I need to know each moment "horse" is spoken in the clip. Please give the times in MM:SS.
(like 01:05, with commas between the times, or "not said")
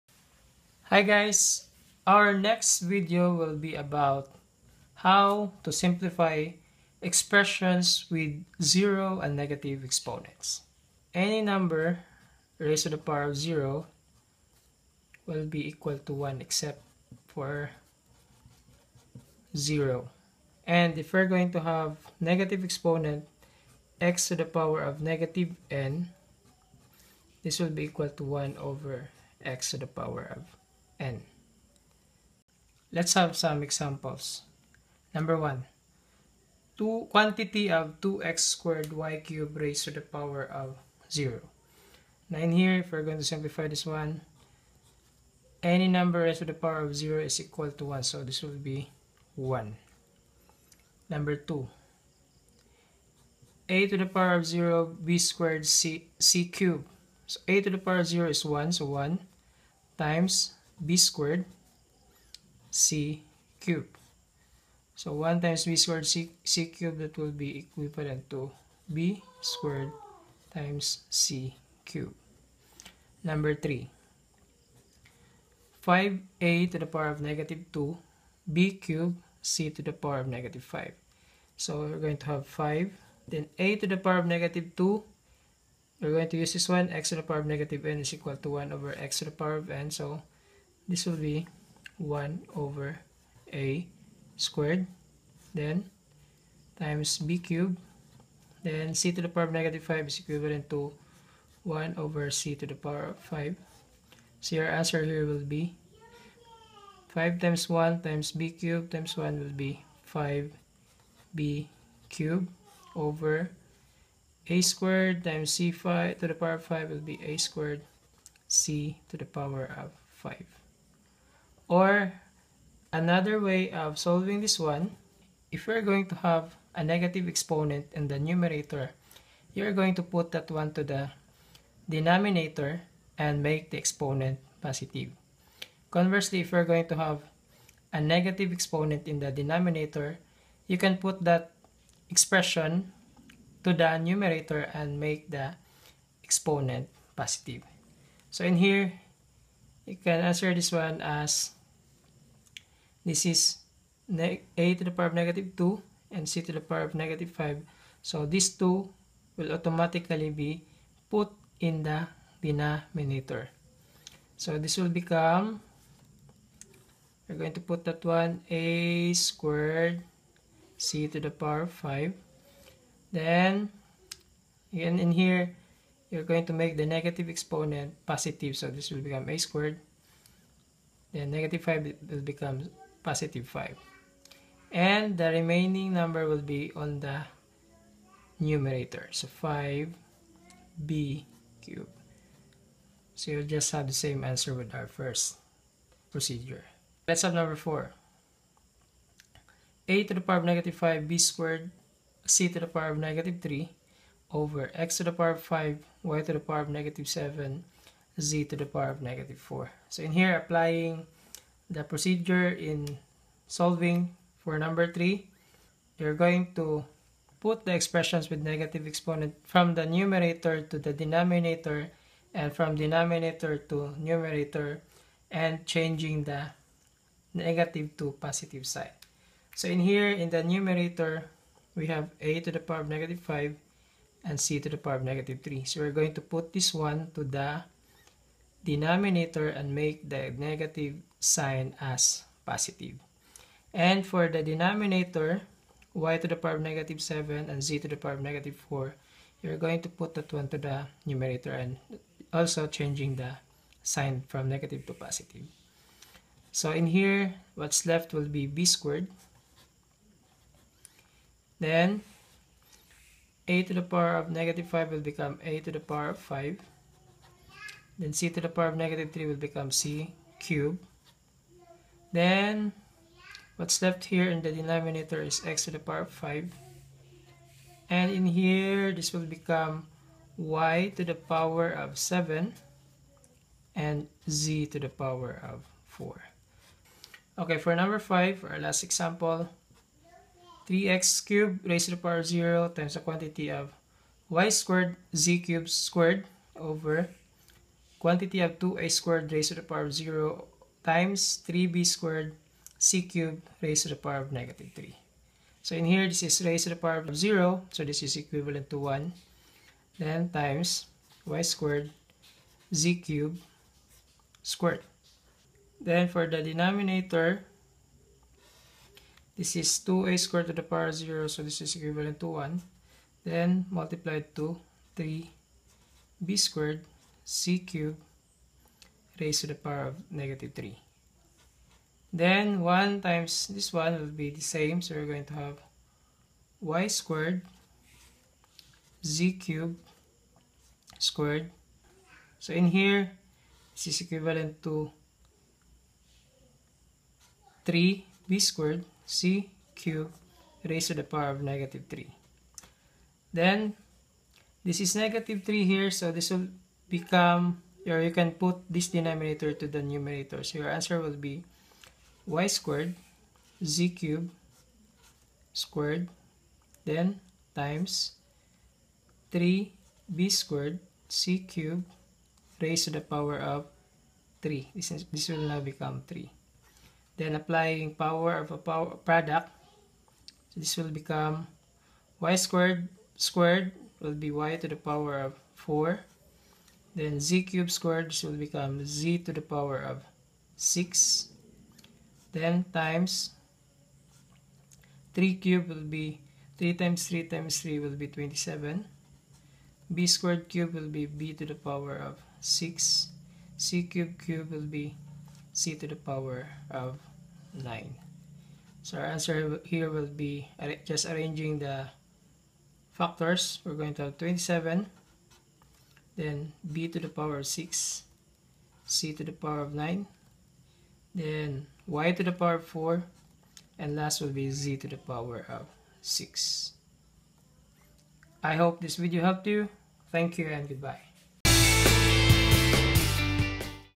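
not said.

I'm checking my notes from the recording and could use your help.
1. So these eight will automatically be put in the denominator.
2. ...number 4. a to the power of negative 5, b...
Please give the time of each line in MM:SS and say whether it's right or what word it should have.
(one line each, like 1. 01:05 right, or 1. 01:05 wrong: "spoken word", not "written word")
1. 02:38 wrong: "two", not "eight"
2. 03:17 right.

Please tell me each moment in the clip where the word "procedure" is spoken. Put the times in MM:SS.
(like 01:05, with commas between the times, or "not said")
03:16, 03:31.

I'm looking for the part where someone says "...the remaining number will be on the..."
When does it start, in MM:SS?
03:05.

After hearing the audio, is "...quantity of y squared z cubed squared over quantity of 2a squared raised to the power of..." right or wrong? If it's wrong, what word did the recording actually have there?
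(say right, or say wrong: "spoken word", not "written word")
right.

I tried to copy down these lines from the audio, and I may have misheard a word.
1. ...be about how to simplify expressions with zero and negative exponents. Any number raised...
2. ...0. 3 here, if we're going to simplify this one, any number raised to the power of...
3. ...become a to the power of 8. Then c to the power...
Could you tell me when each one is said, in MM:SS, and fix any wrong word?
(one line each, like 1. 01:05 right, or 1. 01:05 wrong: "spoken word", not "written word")
1. 00:03 right
2. 00:41 wrong: "9", not "3"
3. 04:25 wrong: "5", not "8".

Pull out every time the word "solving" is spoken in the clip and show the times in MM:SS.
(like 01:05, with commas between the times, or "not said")
02:03, 03:33.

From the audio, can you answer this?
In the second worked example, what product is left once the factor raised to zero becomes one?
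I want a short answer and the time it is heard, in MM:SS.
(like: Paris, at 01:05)
b squared c cubed, at 01:08.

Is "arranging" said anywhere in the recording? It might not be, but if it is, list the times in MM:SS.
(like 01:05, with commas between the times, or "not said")
06:51.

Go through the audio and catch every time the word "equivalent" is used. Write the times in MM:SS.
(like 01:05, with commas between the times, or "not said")
01:07, 01:40, 05:08, 05:21, 05:44.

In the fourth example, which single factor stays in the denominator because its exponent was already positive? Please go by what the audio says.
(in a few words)
x to the power 5.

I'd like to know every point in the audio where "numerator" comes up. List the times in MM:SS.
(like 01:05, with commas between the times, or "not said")
02:08, 02:23, 03:08, 03:39, 03:43, 03:50, 04:11, 05:59.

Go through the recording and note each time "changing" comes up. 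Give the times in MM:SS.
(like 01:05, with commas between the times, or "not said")
03:45, 04:12.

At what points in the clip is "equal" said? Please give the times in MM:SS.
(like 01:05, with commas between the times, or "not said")
00:15, 00:27, 00:47, 01:28.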